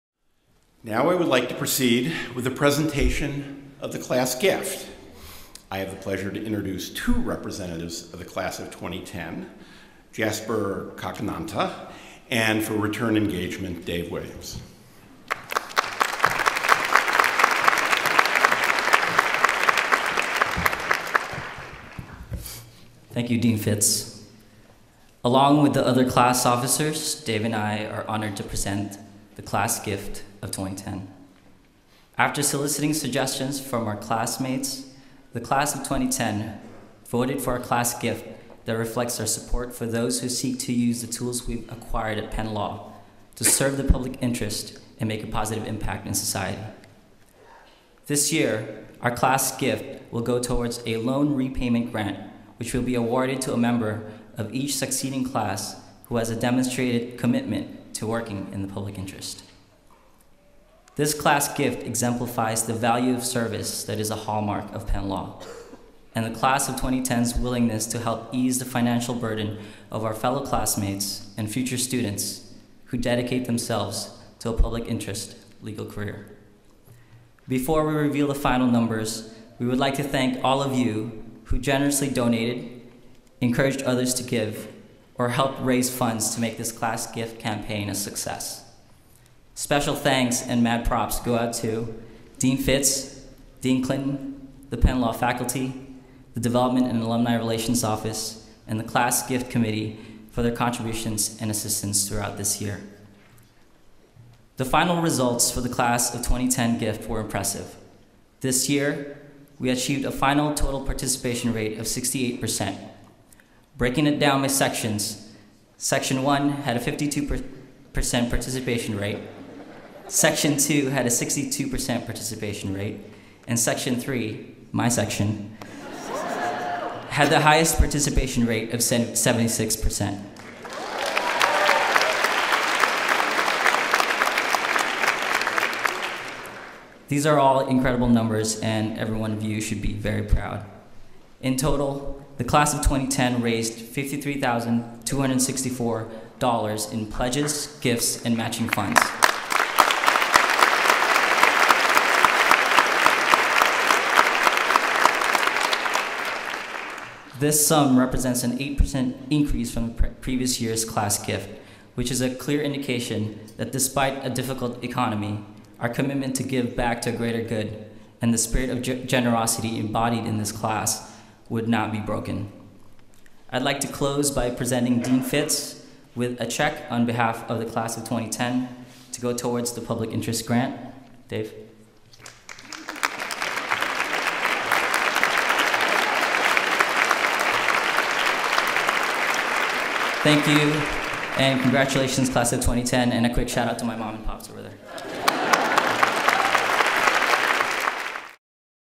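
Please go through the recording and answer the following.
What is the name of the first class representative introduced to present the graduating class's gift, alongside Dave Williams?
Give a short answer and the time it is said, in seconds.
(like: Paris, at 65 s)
Jasper Cacananta, at 10 s.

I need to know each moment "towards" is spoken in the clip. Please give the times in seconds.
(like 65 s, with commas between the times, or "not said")
50 s, 179 s.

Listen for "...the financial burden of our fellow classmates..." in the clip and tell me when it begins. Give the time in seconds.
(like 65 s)
68 s.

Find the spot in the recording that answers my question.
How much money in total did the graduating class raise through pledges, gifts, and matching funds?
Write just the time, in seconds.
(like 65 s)
143 s.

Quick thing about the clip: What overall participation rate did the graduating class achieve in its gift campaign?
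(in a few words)
68%.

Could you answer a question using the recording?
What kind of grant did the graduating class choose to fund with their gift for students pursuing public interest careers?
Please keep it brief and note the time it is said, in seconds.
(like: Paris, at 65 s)
loan repayment grant, at 50 s.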